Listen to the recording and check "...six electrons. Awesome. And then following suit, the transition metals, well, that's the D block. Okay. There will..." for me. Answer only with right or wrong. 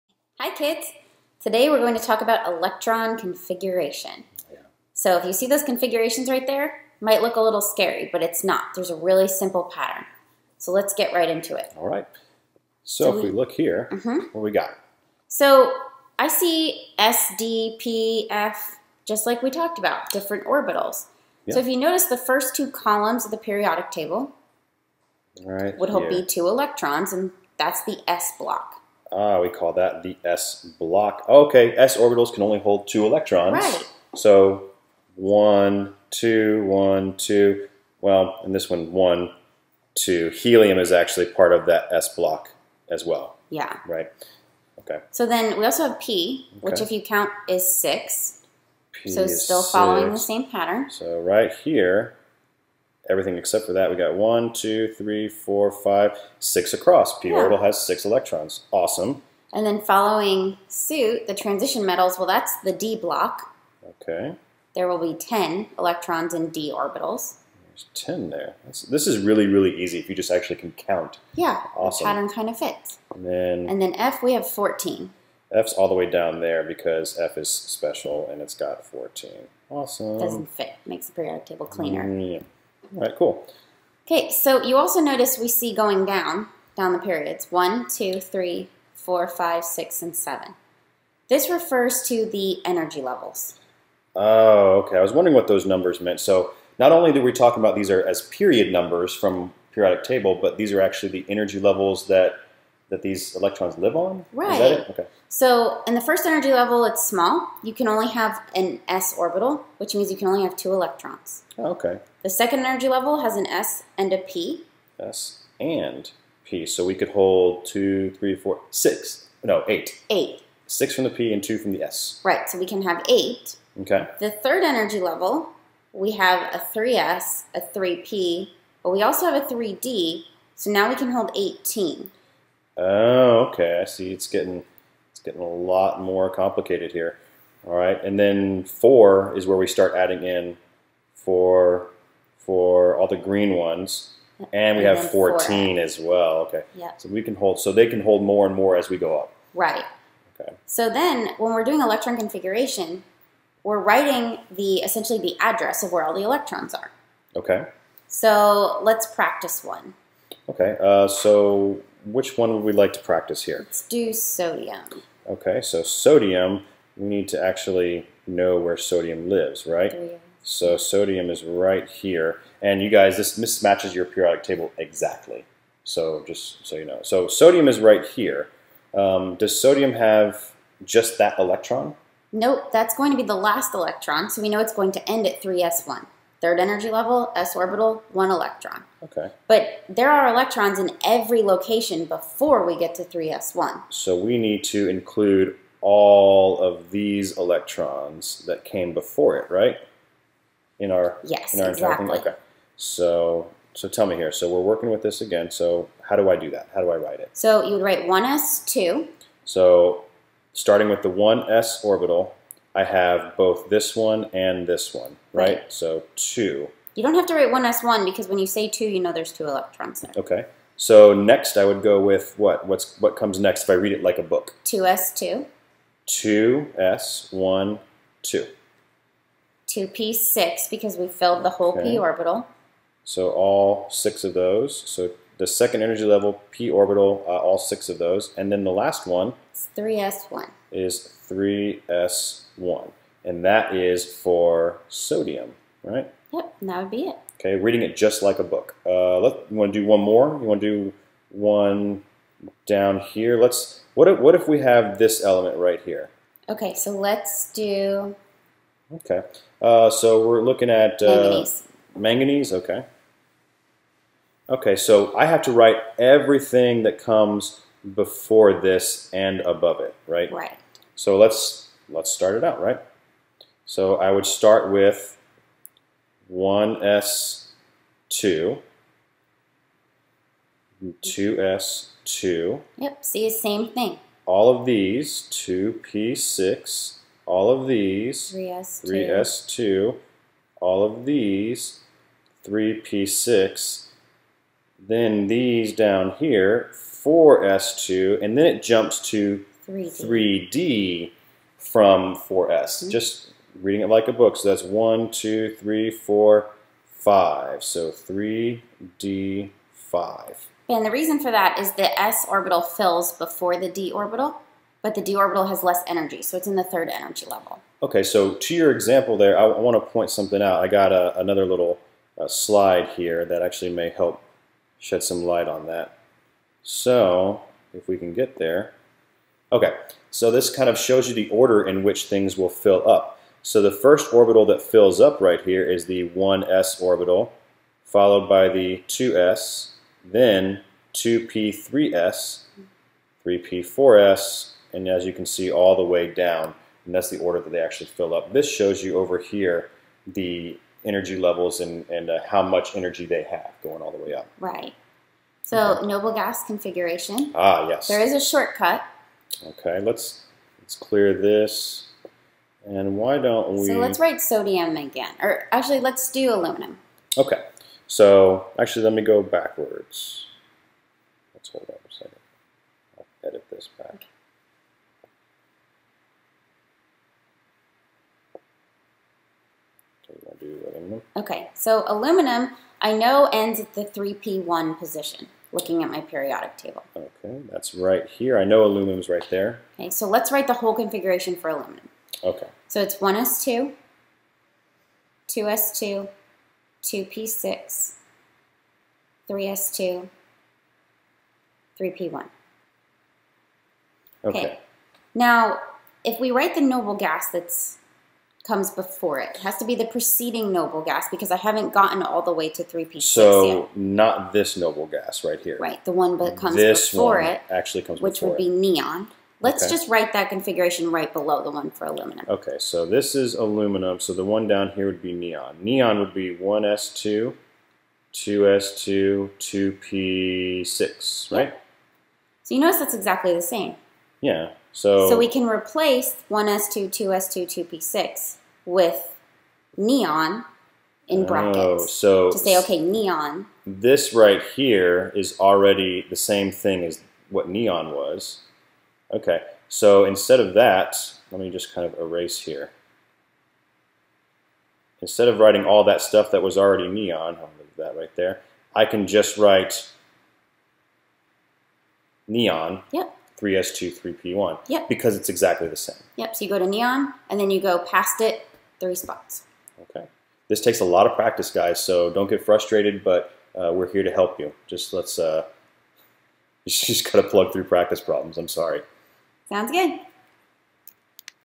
right.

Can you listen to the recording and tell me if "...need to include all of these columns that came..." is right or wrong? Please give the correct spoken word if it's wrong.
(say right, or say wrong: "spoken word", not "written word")
wrong: "electrons", not "columns".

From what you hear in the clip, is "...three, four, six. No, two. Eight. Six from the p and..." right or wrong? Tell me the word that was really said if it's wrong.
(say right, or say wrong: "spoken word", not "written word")
wrong: "eight", not "two".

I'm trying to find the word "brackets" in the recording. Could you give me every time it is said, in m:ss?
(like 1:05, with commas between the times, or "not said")
7:21.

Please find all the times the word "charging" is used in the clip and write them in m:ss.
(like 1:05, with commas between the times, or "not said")
not said.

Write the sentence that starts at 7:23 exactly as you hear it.
This right here is already the same thing as what neon was.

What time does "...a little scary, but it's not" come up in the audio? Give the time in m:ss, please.
0:07.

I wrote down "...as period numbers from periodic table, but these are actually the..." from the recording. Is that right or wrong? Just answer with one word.
right.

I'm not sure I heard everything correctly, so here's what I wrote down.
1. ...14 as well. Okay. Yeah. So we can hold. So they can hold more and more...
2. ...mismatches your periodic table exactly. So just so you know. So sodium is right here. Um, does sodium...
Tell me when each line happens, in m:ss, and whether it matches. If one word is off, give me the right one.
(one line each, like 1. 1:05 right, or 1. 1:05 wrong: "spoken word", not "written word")
1. 2:25 right
2. 2:53 right.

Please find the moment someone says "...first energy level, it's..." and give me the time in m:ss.
1:46.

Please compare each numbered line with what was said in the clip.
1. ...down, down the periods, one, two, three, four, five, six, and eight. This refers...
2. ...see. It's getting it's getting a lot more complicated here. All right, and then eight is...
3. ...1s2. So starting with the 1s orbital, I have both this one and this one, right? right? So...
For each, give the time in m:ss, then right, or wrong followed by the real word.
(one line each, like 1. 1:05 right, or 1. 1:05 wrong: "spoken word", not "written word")
1. 1:26 wrong: "seven", not "eight"
2. 2:13 wrong: "four", not "eight"
3. 3:28 right.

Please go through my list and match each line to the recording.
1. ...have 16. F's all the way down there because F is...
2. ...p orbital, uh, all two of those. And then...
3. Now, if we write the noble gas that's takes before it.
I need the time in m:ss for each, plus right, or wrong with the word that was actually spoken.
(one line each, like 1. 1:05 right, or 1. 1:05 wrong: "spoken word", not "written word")
1. 1:14 wrong: "14", not "16"
2. 3:56 wrong: "six", not "two"
3. 6:45 wrong: "comes", not "takes".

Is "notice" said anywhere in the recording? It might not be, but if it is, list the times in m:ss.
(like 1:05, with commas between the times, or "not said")
0:21, 1:24, 7:12.